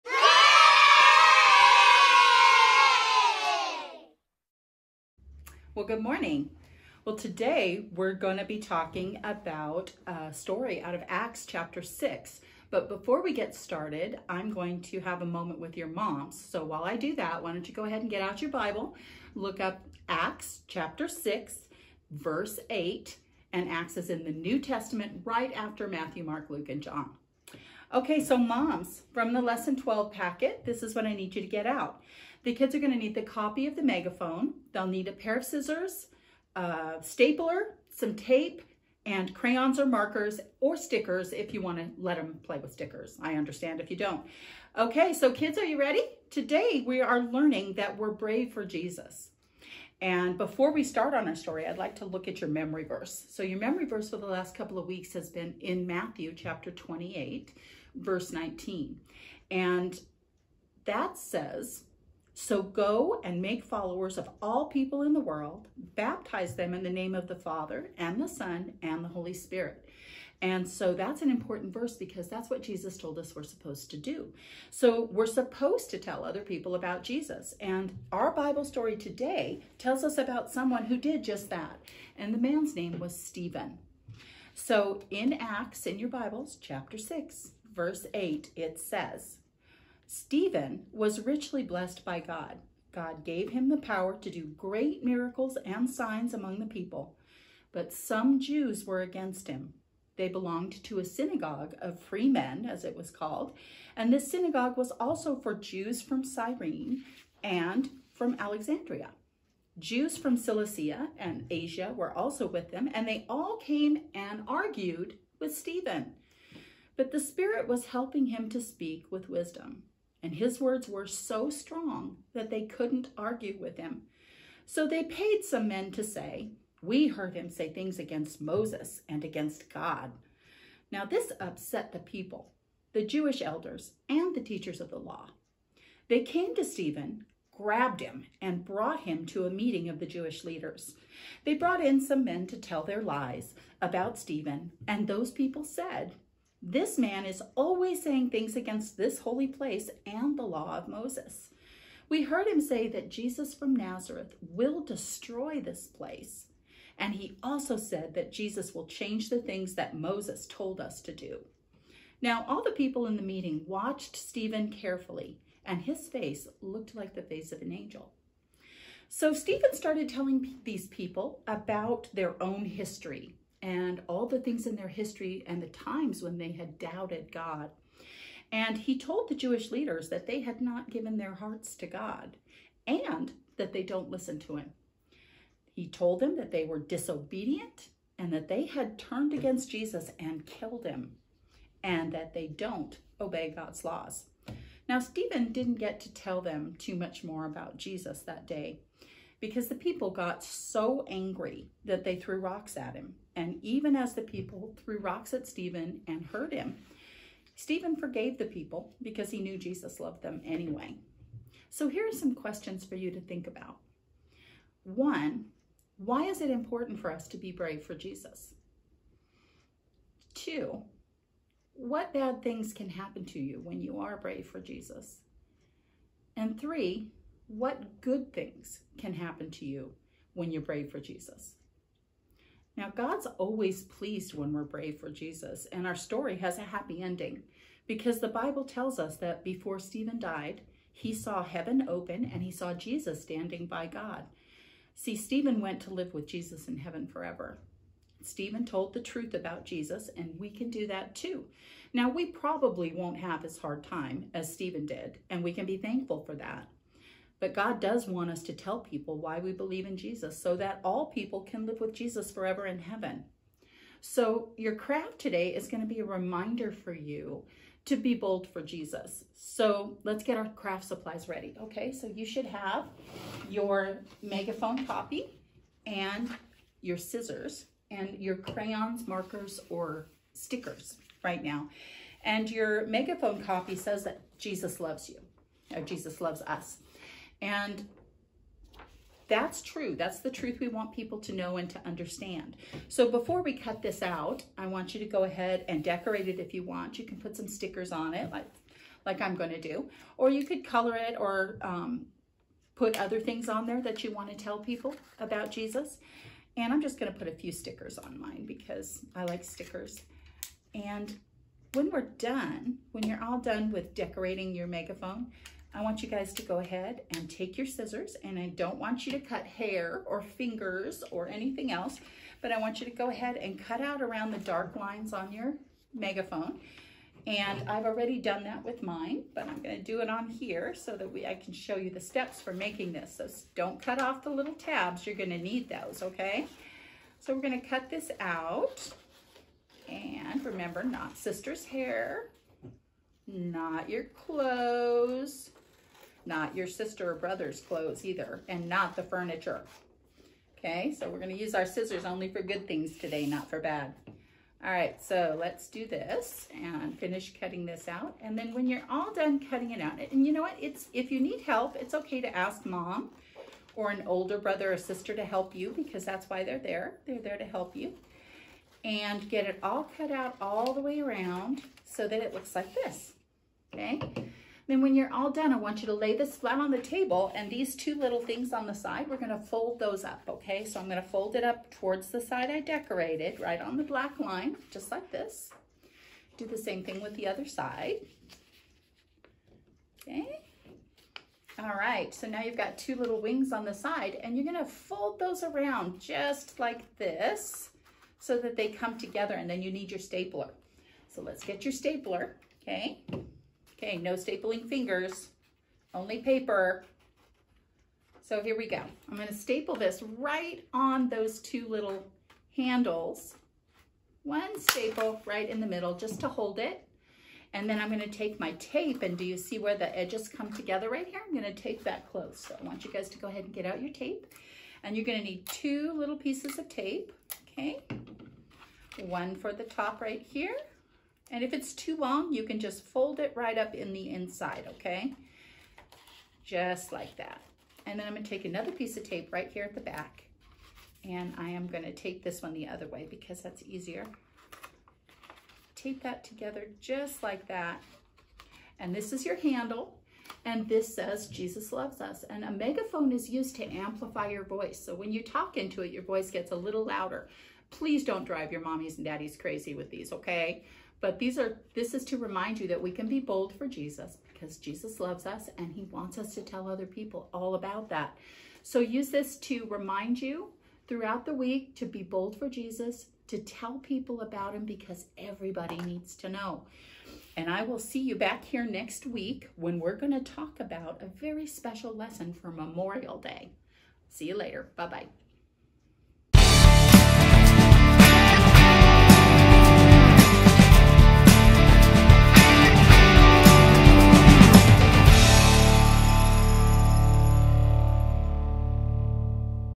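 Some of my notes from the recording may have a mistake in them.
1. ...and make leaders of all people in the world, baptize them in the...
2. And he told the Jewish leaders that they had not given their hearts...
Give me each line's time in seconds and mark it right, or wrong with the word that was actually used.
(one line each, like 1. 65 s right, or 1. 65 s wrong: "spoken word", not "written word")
1. 63 s wrong: "followers", not "leaders"
2. 178 s right.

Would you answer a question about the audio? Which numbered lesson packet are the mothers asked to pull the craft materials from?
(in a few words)
Lesson 12.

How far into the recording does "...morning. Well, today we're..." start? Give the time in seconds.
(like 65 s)
6 s.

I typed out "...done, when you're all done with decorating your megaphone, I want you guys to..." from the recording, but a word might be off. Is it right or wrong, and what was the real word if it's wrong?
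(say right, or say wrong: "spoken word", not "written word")
right.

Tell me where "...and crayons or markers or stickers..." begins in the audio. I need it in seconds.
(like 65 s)
39 s.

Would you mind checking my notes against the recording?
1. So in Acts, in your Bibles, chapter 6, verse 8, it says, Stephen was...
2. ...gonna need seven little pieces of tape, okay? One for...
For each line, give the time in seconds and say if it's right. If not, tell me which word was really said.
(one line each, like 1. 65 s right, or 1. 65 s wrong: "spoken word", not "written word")
1. 84 s right
2. 425 s wrong: "two", not "seven".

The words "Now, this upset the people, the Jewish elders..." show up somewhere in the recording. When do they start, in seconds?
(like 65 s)
130 s.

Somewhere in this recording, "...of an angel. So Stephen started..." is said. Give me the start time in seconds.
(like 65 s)
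167 s.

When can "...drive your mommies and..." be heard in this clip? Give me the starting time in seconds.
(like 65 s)
458 s.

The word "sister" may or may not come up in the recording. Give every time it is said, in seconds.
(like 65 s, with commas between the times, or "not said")
341 s, 346 s, 364 s.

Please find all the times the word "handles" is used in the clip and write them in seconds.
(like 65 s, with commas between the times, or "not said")
412 s, 449 s.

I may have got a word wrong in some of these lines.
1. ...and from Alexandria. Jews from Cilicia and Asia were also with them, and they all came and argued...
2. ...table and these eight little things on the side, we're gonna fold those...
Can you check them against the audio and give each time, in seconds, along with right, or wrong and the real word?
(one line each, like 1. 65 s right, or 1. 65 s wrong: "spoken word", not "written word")
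1. 107 s right
2. 376 s wrong: "two", not "eight".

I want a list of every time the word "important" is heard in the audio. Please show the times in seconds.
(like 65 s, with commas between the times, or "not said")
71 s, 216 s.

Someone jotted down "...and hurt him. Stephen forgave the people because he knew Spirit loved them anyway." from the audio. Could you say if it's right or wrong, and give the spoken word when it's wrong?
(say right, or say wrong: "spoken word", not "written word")
wrong: "Jesus", not "Spirit".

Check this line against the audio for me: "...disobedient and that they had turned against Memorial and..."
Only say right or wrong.
wrong.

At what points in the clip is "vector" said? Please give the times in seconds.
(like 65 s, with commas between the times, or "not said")
not said.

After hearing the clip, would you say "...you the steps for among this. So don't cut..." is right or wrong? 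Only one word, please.
wrong.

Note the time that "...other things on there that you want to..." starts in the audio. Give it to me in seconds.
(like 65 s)
302 s.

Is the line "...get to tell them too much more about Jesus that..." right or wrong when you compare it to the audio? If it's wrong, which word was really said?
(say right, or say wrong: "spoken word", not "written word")
right.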